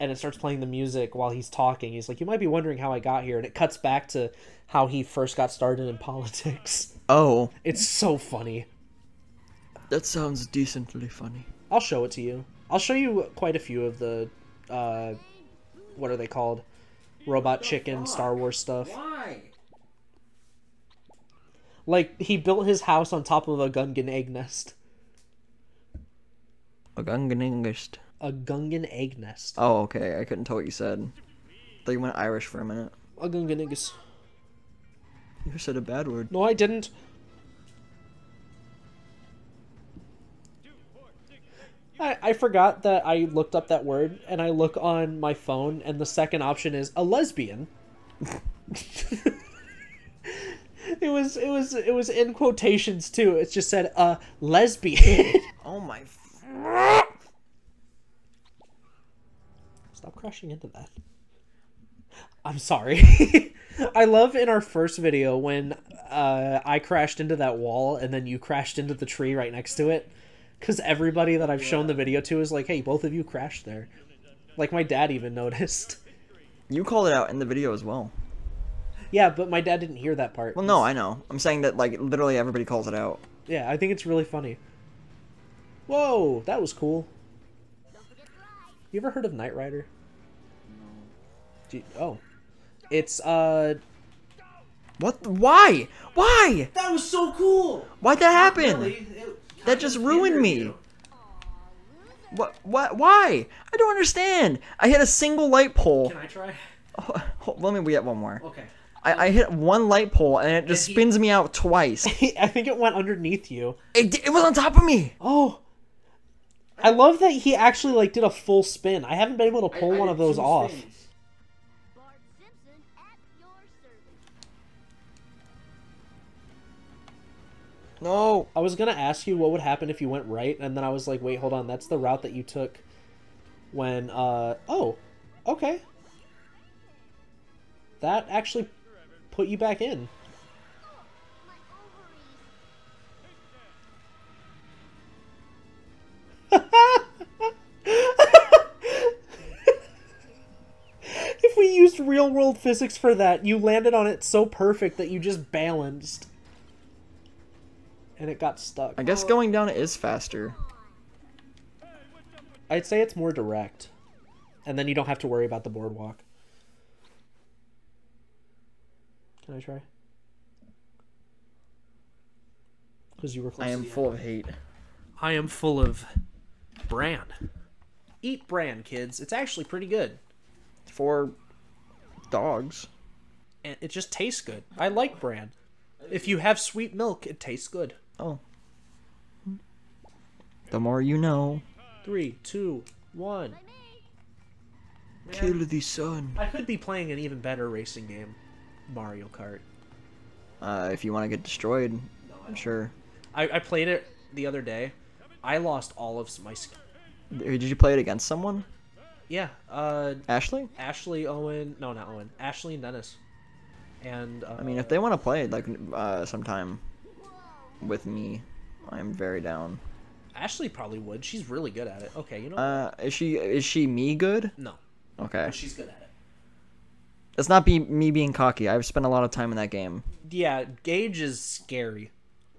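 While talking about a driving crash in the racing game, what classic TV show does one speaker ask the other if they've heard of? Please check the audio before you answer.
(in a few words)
Knight Rider.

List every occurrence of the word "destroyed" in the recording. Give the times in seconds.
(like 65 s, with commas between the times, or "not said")
201 s.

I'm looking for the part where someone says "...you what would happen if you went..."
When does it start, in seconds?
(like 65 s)
129 s.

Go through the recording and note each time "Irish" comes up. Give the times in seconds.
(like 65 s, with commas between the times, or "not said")
32 s.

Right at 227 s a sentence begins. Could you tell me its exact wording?
It's not be me being cocky.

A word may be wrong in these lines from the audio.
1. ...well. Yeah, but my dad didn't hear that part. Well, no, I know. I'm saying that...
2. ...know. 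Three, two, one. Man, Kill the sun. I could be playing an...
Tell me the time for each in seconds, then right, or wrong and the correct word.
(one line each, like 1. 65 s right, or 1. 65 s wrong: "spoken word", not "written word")
1. 77 s right
2. 191 s right.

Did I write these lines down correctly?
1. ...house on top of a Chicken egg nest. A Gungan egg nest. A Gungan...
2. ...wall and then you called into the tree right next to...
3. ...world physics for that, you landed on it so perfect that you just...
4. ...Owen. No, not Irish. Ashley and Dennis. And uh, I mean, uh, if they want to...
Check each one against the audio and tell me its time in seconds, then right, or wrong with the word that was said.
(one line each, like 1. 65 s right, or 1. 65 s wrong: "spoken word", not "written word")
1. 22 s wrong: "Gungan", not "Chicken"
2. 67 s wrong: "crashed", not "called"
3. 152 s right
4. 211 s wrong: "Owen", not "Irish".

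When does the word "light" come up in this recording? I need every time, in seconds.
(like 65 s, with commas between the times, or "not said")
105 s, 109 s.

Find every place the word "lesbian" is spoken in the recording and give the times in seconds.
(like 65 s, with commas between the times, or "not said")
47 s, 54 s.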